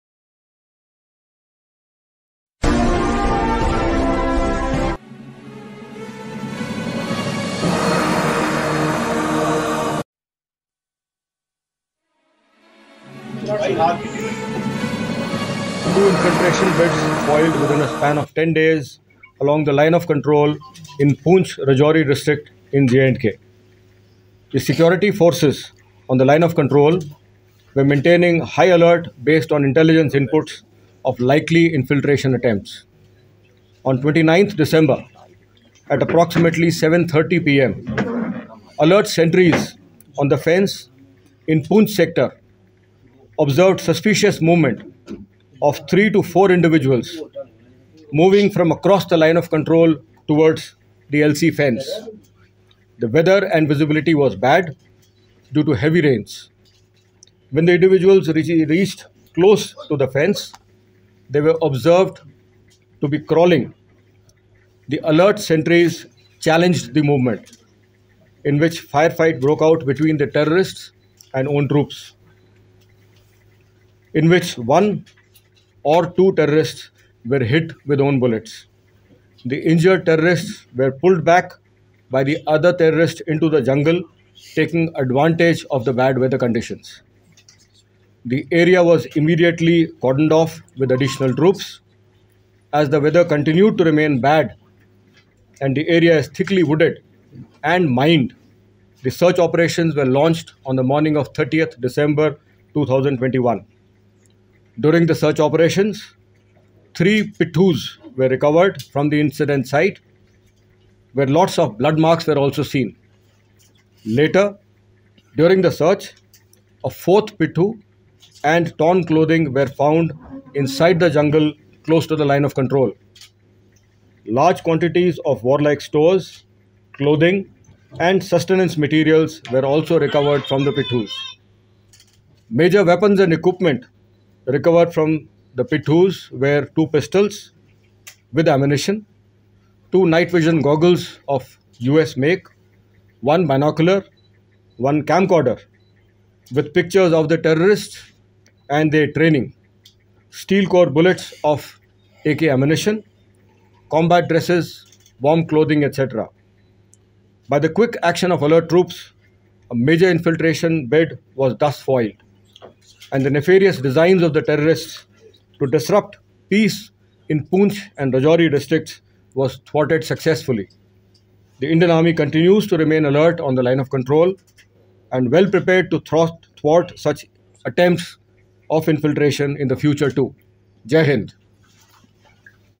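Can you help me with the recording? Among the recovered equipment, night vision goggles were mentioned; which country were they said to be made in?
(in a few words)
US.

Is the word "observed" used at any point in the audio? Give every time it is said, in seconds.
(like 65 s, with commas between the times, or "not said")
43 s, 61 s.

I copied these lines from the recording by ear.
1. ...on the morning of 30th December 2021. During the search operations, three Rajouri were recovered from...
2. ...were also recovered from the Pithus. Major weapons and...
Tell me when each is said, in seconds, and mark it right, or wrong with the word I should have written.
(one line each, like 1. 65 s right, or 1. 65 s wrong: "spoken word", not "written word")
1. 100 s wrong: "Pithus", not "Rajouri"
2. 129 s right.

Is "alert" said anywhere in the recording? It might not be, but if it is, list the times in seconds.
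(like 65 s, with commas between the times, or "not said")
28 s, 38 s, 65 s, 158 s, 173 s.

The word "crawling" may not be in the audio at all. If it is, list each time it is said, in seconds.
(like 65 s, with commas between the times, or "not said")
63 s.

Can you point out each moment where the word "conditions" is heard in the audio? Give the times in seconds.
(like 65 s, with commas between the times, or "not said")
86 s.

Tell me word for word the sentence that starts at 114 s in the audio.
Later, during the search, a fourth pithu and torn clothing were found inside the jungle close to the line of control.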